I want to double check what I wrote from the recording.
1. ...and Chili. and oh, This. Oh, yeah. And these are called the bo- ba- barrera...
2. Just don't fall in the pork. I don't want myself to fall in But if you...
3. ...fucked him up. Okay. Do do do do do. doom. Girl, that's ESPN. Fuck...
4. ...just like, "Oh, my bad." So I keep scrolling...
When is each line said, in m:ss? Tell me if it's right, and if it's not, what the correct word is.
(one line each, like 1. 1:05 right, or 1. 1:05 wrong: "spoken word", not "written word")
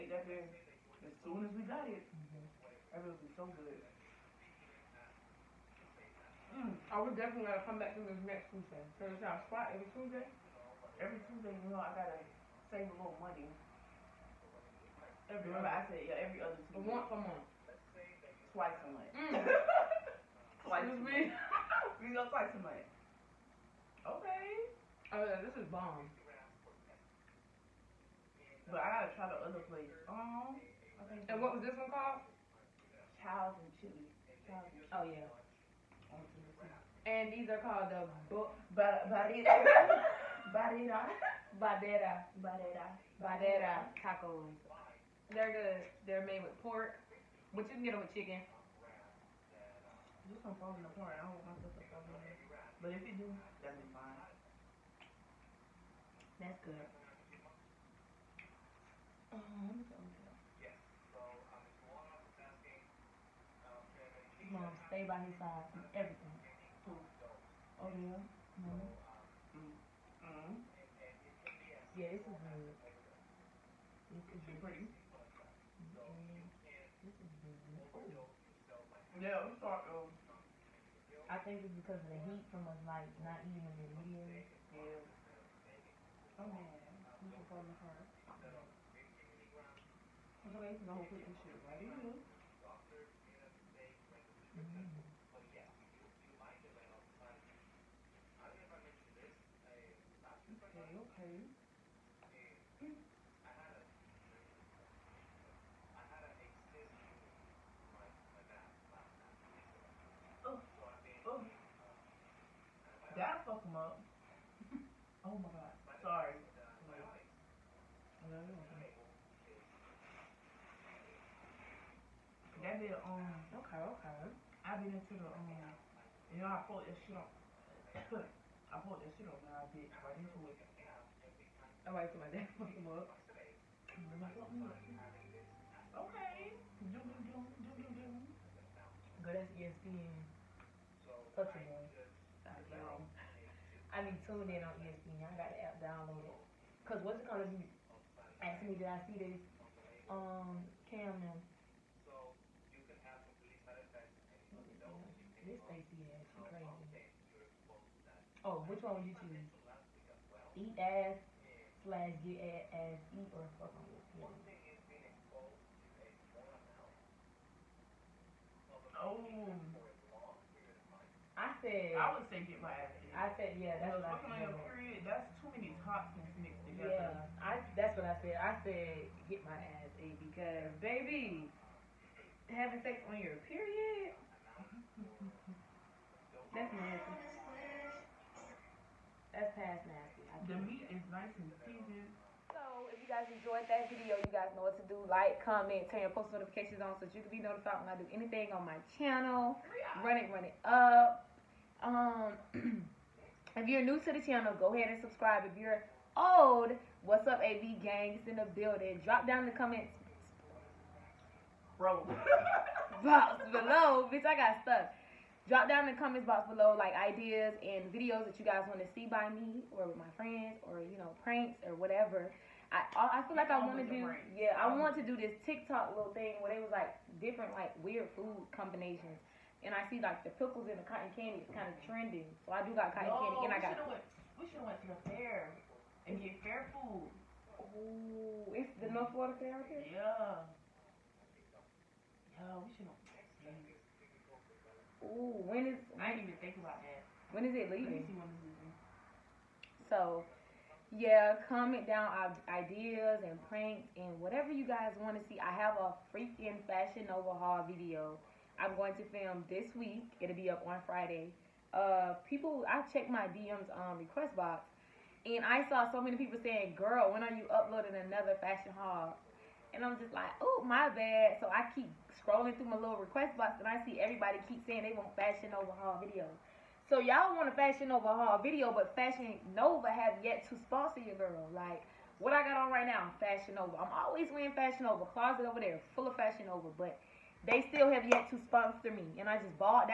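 1. 0:33 wrong: "Chili", not "This"
2. 0:50 right
3. 2:12 right
4. 4:29 right.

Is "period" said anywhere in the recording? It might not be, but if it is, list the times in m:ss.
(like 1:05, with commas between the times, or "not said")
2:54, 3:03.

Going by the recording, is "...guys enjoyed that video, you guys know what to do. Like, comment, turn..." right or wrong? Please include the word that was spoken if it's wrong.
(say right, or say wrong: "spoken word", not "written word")
right.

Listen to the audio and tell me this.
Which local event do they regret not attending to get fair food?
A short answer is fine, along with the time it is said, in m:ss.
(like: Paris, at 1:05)
North Florida Fair, at 3:58.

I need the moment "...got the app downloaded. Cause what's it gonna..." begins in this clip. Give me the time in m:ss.
2:25.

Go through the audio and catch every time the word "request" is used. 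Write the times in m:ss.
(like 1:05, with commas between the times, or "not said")
4:23, 4:33.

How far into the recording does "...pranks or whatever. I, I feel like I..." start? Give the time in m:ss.
3:41.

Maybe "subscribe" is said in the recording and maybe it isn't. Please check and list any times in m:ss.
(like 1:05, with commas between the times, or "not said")
3:25.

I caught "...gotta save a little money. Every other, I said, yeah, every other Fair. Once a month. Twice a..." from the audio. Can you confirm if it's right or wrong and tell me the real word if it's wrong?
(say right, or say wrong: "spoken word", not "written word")
wrong: "Tuesday", not "Fair".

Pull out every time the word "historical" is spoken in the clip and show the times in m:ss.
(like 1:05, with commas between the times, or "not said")
not said.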